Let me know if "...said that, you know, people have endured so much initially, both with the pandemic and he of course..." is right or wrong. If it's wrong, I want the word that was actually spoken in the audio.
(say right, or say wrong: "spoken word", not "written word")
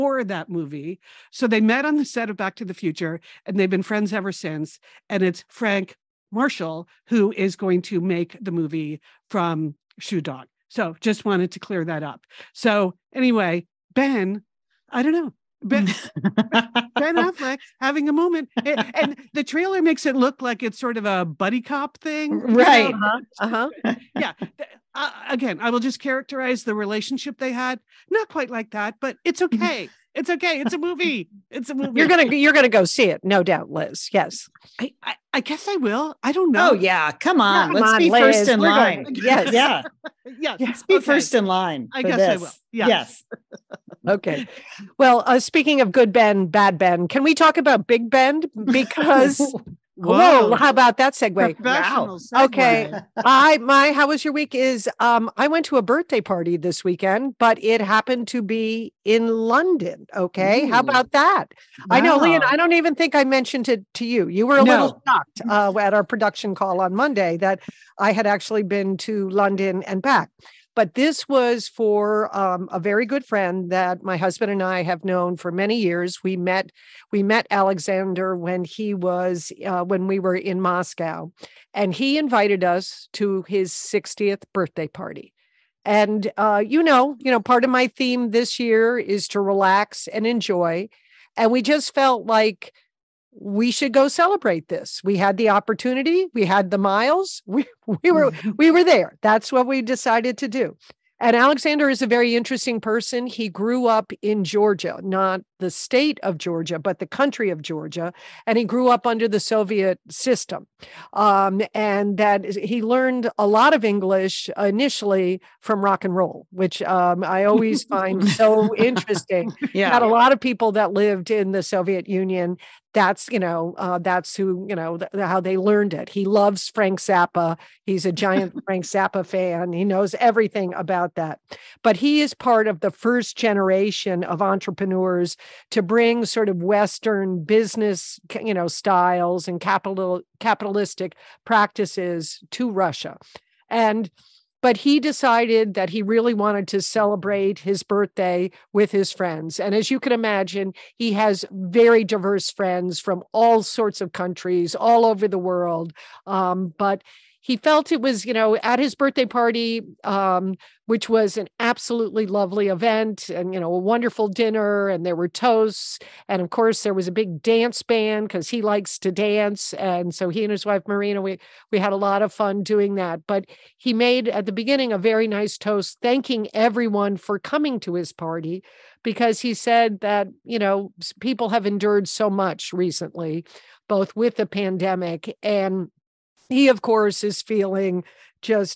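wrong: "recently", not "initially".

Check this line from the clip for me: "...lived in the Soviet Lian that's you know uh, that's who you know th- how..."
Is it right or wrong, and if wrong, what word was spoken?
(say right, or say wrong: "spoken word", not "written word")
wrong: "Union", not "Lian".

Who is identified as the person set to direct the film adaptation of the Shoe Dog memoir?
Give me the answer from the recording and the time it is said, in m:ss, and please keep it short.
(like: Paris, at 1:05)
Frank Marshall, at 0:05.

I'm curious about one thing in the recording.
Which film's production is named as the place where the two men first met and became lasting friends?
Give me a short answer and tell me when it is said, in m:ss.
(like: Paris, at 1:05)
Back to the Future, at 0:02.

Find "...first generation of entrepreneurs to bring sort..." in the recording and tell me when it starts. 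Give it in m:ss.
2:12.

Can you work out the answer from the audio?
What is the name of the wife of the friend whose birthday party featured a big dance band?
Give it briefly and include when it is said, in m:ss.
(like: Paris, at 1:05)
Marina, at 2:50.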